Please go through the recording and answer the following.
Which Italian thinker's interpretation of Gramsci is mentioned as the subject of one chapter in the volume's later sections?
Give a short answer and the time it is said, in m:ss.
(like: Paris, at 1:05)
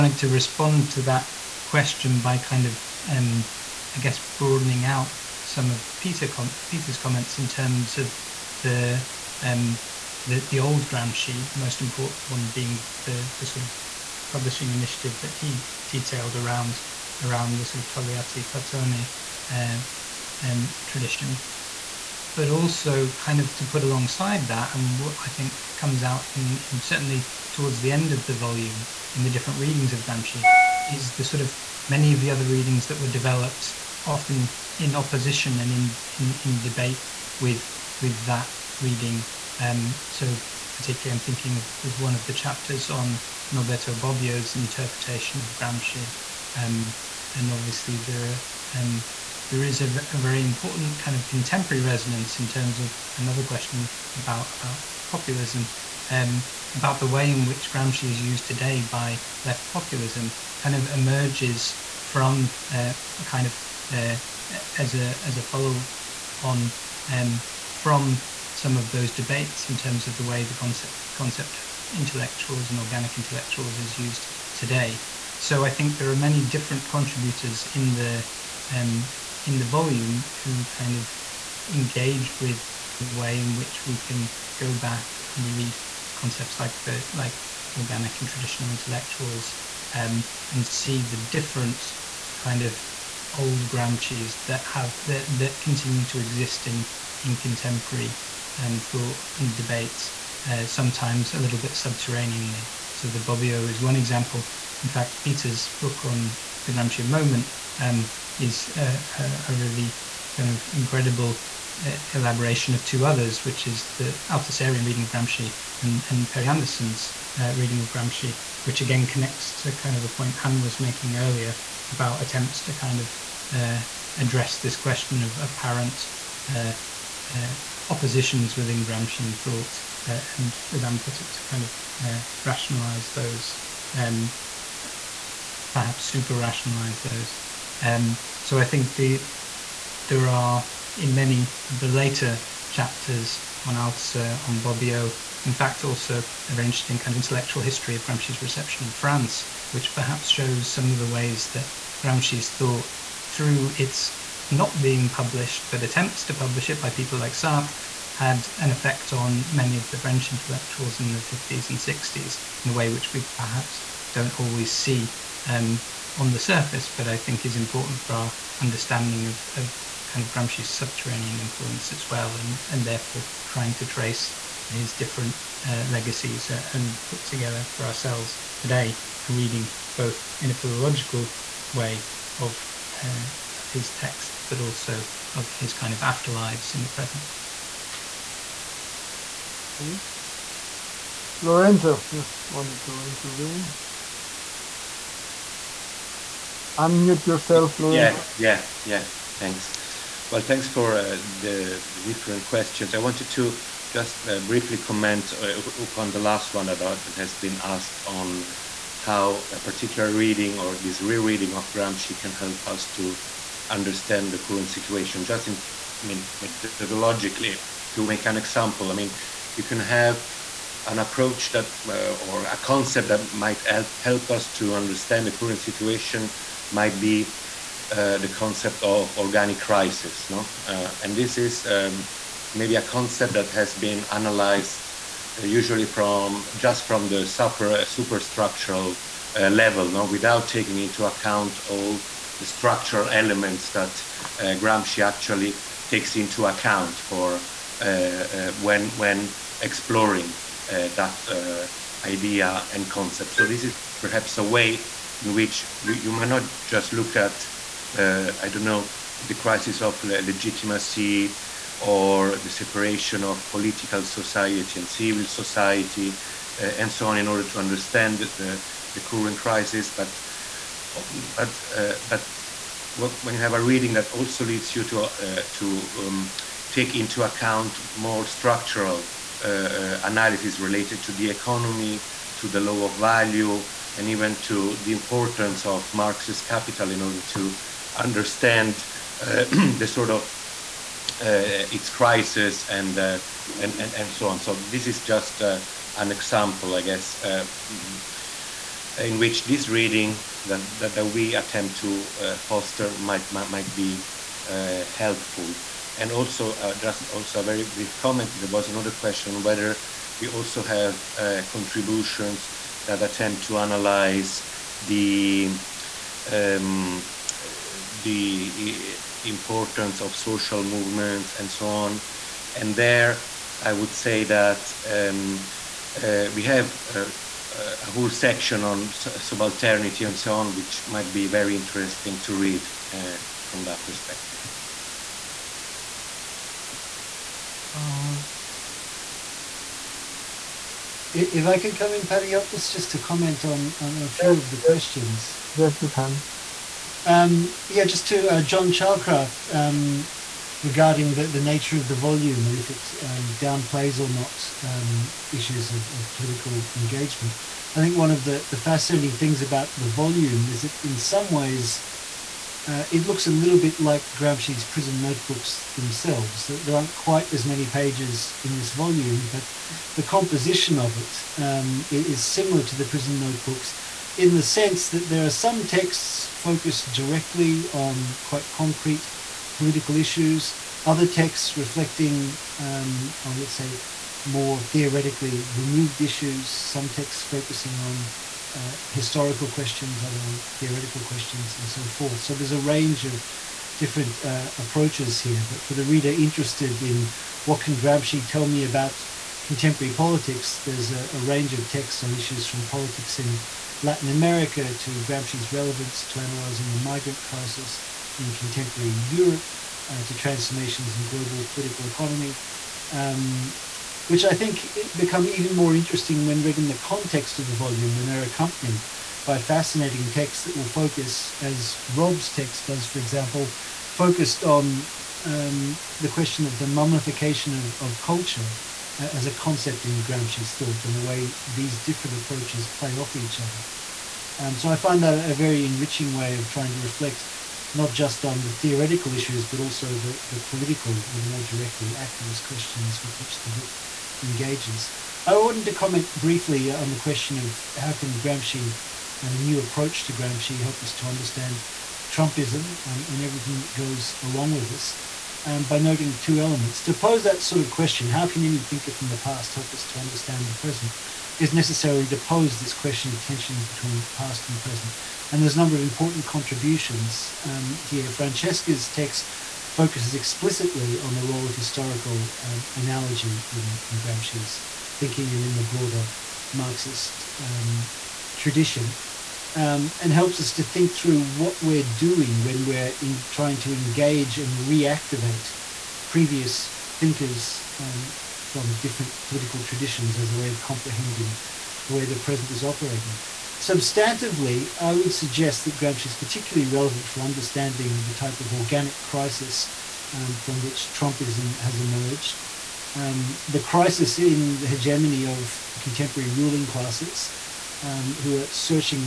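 Norberto Bobbio, at 0:43.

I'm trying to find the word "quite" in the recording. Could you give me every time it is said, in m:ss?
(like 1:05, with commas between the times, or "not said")
6:06, 6:18.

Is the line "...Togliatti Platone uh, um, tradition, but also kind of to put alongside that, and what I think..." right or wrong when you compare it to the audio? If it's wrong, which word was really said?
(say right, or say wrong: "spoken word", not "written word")
right.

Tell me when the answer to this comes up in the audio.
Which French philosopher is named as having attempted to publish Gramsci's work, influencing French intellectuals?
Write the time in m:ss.
2:37.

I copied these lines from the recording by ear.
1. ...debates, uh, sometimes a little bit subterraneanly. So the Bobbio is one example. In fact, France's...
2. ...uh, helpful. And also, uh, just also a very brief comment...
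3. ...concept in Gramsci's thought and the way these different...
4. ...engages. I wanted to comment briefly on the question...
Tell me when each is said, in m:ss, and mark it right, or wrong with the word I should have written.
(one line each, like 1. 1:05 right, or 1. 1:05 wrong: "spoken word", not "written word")
1. 1:39 wrong: "Peter", not "France"
2. 5:04 right
3. 7:09 right
4. 7:24 right.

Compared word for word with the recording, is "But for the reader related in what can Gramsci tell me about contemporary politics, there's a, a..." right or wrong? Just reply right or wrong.
wrong.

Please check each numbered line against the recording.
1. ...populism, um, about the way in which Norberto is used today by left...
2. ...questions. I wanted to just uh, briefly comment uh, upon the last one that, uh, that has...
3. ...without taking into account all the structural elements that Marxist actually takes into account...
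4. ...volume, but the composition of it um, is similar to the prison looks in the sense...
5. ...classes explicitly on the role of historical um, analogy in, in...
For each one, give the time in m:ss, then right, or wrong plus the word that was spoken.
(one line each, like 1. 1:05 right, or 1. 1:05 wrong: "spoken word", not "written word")
1. 0:55 wrong: "Gramsci", not "Norberto"
2. 3:22 right
3. 4:00 wrong: "Gramsci", not "Marxist"
4. 6:08 wrong: "notebooks", not "looks"
5. 7:49 wrong: "focuses", not "classes".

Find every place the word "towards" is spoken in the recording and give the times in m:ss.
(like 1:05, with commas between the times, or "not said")
0:27.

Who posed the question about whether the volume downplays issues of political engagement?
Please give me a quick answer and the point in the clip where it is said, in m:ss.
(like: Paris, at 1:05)
John Chalcraft, at 5:48.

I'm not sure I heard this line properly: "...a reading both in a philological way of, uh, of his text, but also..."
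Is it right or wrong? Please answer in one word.
right.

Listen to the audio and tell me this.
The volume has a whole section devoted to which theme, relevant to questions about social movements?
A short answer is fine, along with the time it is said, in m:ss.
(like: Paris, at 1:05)
Subalternity, at 5:28.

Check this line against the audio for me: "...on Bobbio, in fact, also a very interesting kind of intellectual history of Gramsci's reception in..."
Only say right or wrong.
right.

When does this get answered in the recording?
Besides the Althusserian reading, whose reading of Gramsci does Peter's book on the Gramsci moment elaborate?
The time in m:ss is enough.
1:56.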